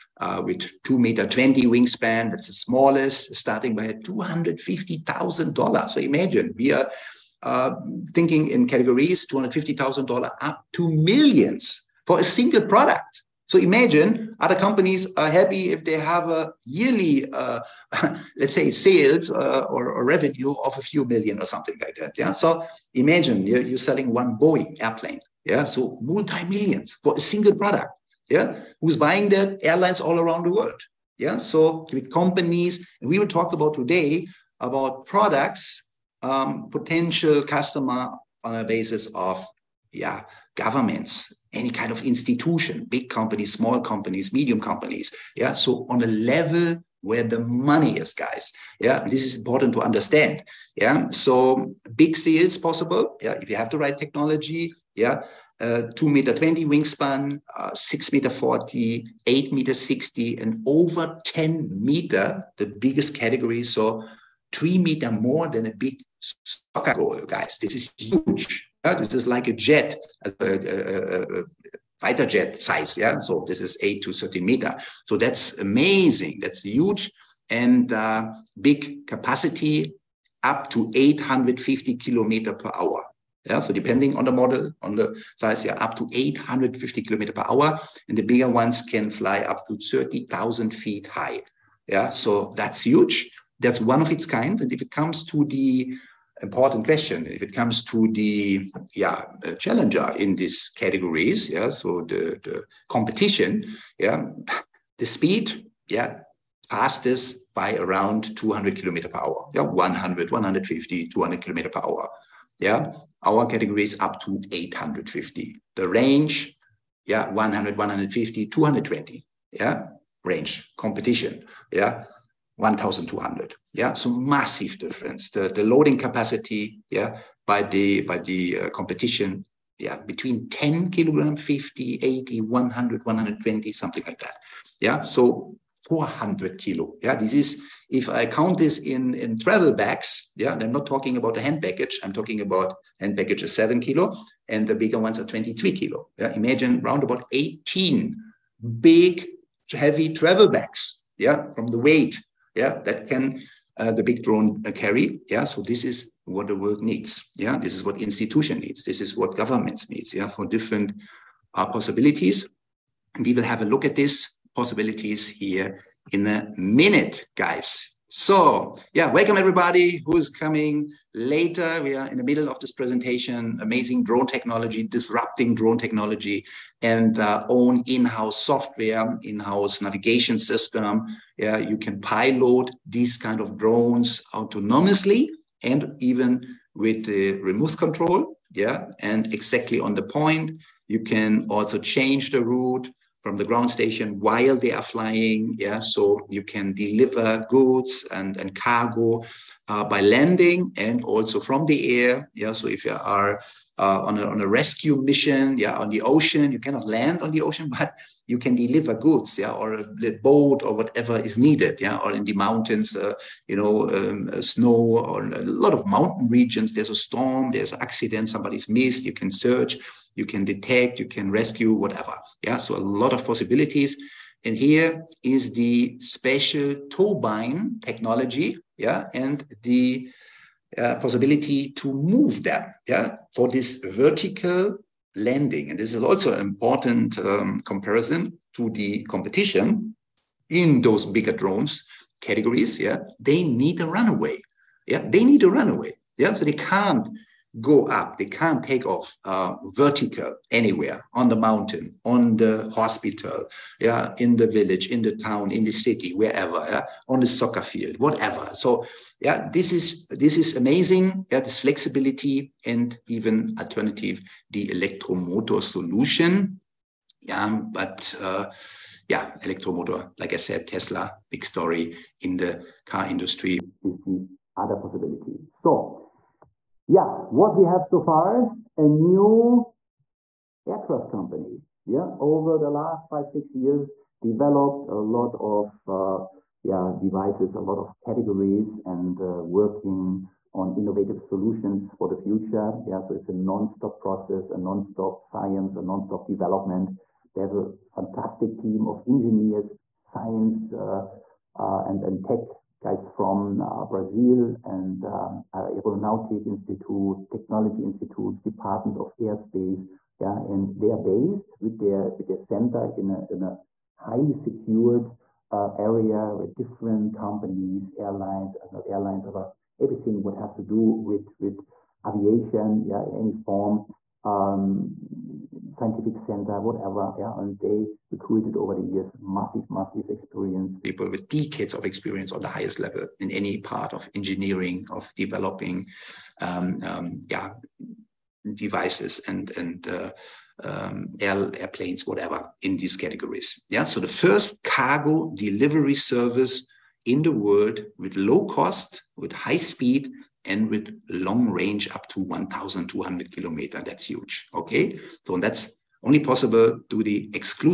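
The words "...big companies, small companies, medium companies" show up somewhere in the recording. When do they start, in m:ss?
0:42.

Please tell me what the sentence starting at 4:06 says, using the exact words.
Yeah, so they can't go up.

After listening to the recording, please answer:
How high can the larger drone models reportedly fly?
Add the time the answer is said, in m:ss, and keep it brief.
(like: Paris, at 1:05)
30,000 feet, at 1:29.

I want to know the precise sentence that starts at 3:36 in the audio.
There's a storm, there's an accident, somebody's missed.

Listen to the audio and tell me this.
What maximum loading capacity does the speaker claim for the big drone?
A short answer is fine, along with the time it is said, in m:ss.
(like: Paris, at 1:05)
400 kilograms, at 2:15.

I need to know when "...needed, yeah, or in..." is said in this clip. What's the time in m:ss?
3:31.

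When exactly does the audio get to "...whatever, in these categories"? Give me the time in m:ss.
5:42.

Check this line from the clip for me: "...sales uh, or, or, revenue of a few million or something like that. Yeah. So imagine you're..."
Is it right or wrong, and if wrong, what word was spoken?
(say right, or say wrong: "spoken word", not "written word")
right.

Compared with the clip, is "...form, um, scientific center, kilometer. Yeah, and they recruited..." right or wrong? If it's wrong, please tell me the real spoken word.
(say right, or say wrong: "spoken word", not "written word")
wrong: "whatever", not "kilometer".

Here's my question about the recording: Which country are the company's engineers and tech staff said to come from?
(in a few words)
Brazil.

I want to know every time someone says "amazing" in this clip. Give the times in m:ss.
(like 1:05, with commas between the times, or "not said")
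1:15, 2:53, 4:20.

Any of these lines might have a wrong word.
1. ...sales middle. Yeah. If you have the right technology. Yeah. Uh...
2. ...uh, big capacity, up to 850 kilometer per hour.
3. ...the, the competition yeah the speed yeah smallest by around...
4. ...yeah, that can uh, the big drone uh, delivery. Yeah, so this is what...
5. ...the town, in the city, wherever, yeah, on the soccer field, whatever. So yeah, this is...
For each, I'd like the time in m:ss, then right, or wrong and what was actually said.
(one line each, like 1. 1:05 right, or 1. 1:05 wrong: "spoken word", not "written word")
1. 0:52 wrong: "possible", not "middle"
2. 1:17 right
3. 1:42 wrong: "fastest", not "smallest"
4. 2:32 wrong: "carry", not "delivery"
5. 4:15 right.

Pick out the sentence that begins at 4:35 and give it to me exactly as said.
So yeah, what we have so far, a new aircraft company.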